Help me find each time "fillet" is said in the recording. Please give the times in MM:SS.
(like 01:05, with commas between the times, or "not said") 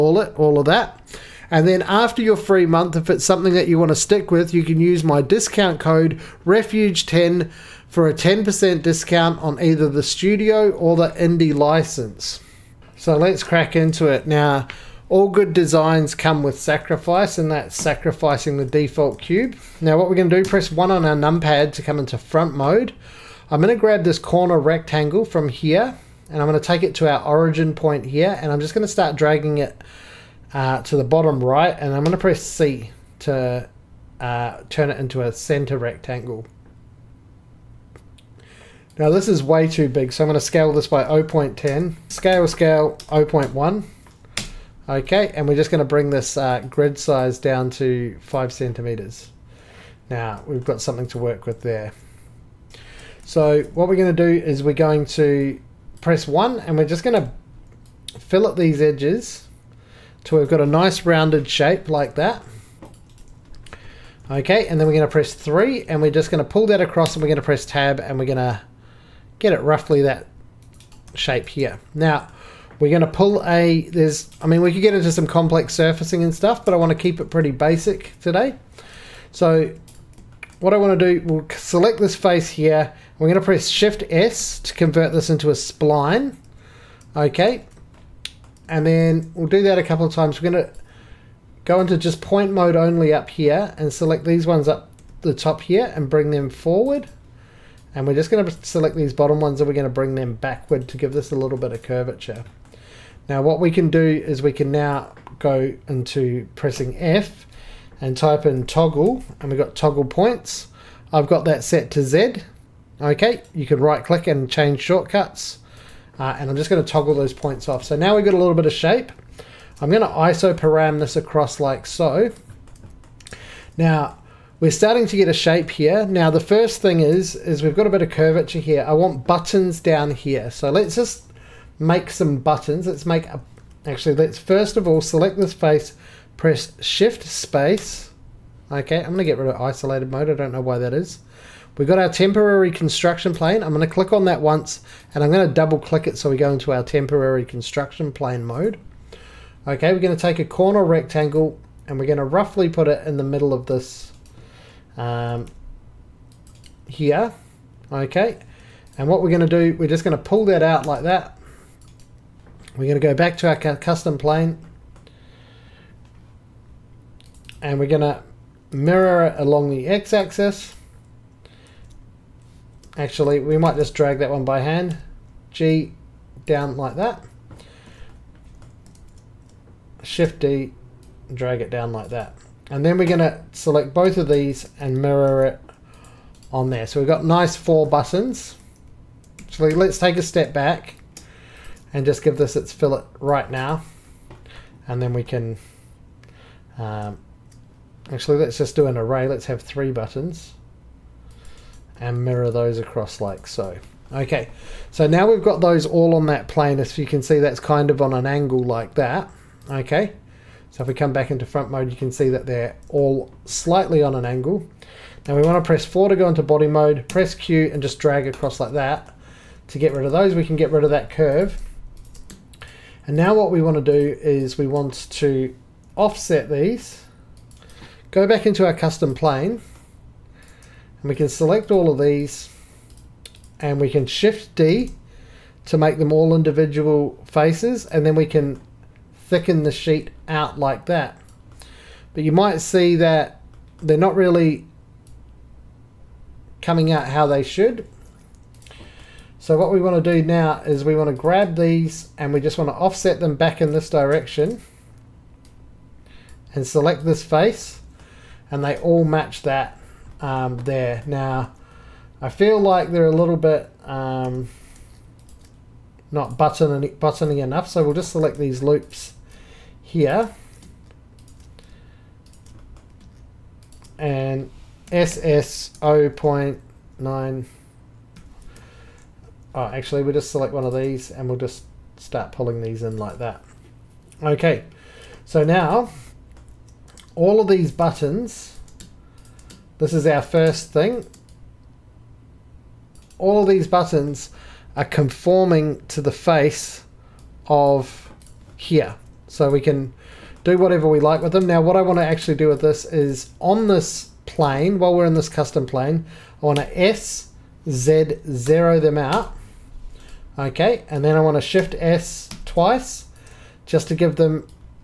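00:58, 03:12.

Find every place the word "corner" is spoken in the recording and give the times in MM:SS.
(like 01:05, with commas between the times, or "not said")
00:24, 02:30.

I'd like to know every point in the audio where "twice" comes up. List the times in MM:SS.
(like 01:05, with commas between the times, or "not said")
05:12.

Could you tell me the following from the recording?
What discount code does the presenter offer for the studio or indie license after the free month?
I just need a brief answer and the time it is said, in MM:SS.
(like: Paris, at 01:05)
REFUGE10, at 00:06.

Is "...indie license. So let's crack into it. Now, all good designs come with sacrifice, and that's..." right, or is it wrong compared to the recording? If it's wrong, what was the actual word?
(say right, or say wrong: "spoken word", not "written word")
right.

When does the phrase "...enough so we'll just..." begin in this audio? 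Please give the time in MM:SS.
04:27.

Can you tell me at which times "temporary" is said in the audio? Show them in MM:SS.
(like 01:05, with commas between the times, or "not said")
02:22, 02:26.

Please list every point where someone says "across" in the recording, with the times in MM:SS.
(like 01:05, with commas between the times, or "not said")
01:06, 02:01, 03:22, 03:38.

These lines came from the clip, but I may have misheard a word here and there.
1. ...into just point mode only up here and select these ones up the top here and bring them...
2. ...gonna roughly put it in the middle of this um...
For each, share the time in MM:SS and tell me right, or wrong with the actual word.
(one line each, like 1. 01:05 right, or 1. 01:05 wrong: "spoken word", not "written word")
1. 01:31 right
2. 02:32 right.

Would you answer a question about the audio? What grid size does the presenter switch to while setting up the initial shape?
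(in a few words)
5 centimeters.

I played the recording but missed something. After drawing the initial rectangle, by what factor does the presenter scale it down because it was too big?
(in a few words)
0.1.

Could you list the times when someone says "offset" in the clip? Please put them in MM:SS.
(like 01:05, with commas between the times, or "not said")
03:45, 04:12.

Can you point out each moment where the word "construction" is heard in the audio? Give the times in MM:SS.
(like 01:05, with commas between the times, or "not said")
02:22, 02:27.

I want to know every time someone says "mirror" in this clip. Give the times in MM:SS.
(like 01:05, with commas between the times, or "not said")
02:48, 03:05, 03:22.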